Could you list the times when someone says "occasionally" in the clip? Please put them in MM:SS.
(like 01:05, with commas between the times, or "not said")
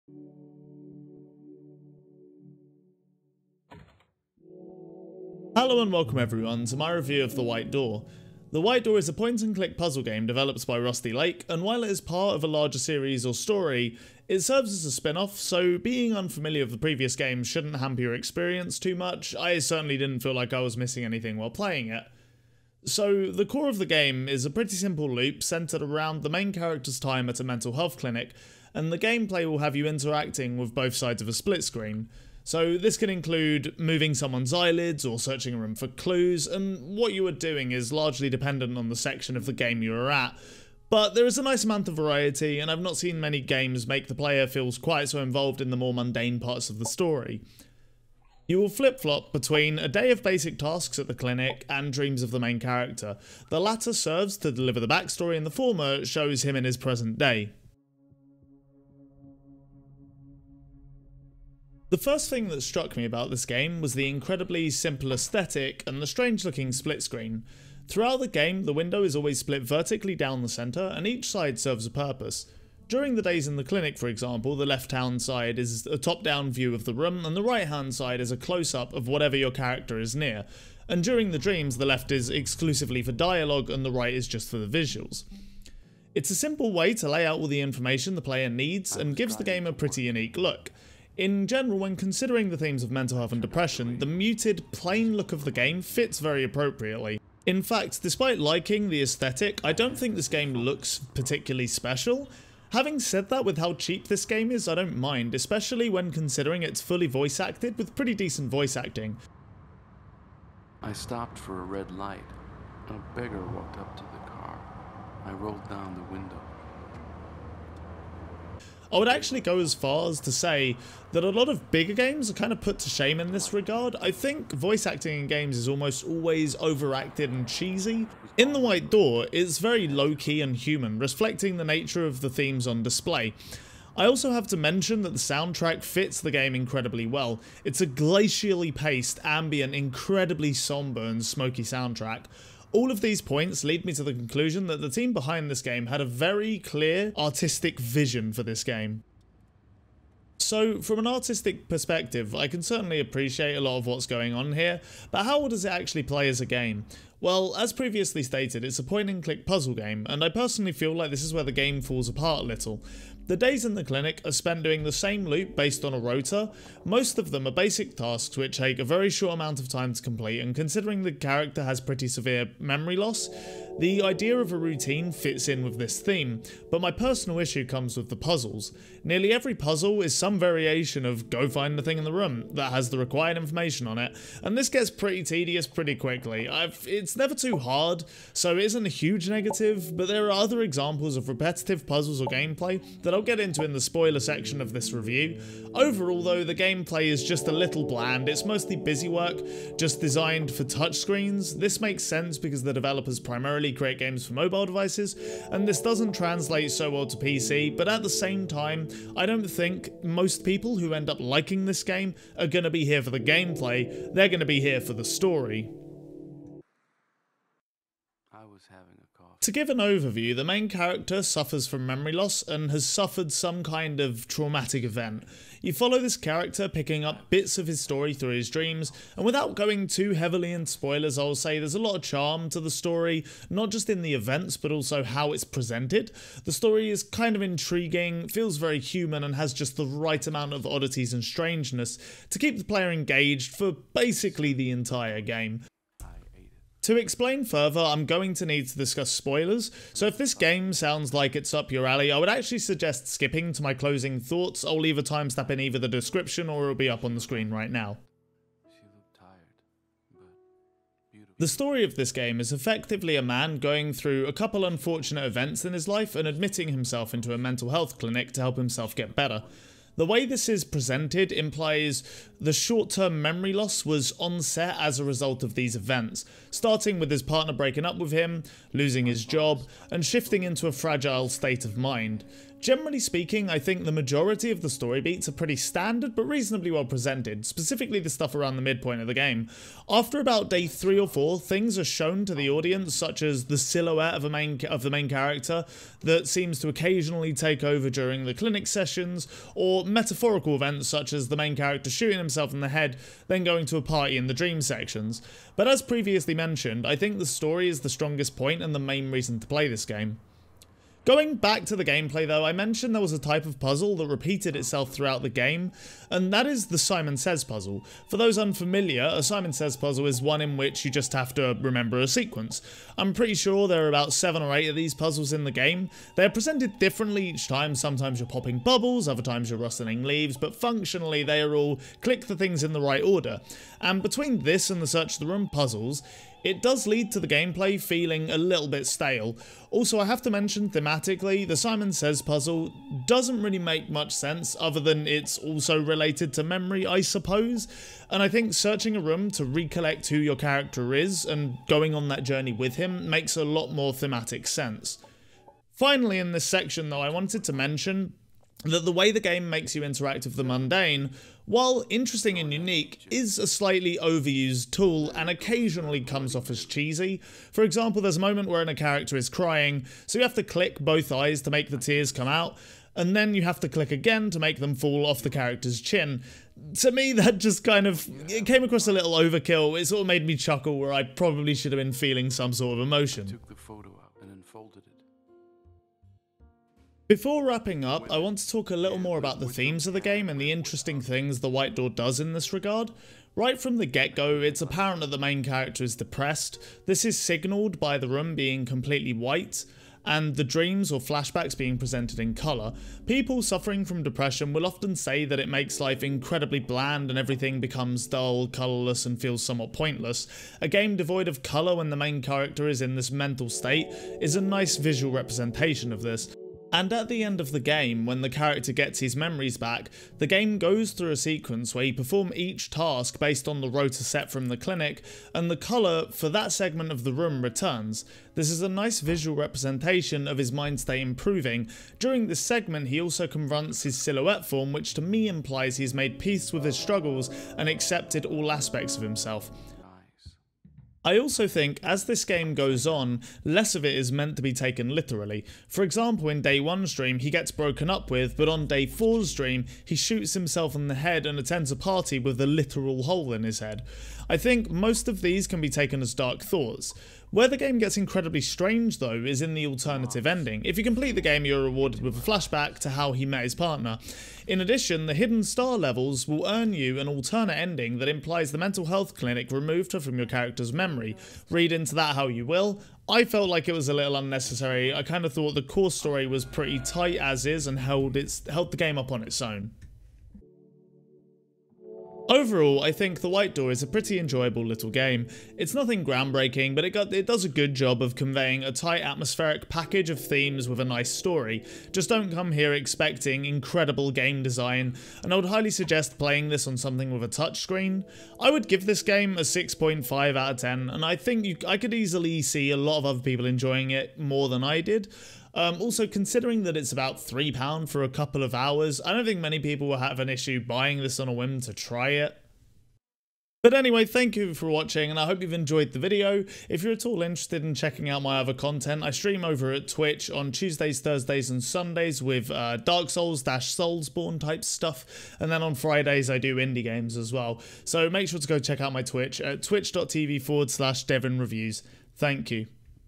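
04:56, 06:05.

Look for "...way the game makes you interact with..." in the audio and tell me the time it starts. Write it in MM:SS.
05:58.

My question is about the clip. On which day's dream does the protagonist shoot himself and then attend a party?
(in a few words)
Day 4.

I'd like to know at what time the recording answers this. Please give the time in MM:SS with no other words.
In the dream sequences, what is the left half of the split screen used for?
01:23.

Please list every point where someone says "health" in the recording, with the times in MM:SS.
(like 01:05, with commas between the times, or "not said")
00:27, 01:33, 04:27, 07:48.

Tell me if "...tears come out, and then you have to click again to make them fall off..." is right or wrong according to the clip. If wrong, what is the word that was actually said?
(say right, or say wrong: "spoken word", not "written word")
right.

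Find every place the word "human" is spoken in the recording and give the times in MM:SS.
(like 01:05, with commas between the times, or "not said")
02:10, 03:58.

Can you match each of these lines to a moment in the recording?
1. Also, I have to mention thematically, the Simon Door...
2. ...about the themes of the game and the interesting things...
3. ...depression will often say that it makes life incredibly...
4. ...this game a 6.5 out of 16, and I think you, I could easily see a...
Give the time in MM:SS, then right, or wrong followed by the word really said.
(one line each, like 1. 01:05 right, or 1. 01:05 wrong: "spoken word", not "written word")
1. 05:39 wrong: "Says", not "Door"
2. 06:29 right
3. 06:44 right
4. 08:18 wrong: "10", not "16".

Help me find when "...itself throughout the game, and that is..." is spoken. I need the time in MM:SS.
05:14.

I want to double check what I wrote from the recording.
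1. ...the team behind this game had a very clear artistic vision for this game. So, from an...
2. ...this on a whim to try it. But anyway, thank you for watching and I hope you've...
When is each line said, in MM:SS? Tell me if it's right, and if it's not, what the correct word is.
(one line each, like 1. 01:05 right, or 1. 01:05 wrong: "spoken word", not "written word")
1. 02:24 right
2. 08:30 right.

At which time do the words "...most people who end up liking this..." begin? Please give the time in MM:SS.
03:30.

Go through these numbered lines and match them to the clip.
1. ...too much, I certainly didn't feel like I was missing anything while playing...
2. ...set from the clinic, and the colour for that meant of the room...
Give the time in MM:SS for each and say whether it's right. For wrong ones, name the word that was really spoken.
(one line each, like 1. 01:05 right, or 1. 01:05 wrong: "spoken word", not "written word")
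1. 00:18 right
2. 07:04 wrong: "segment", not "meant".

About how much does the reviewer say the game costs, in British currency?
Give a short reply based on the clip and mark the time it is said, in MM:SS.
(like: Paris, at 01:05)
£3, at 08:26.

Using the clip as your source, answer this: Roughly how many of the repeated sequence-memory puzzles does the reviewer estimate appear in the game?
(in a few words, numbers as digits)
7 or 8.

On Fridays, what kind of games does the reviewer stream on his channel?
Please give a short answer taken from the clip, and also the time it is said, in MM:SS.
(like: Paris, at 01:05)
Indie games, at 08:46.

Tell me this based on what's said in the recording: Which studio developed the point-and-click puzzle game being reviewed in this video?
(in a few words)
Rusty Lake.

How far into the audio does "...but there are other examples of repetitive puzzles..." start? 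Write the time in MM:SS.
03:09.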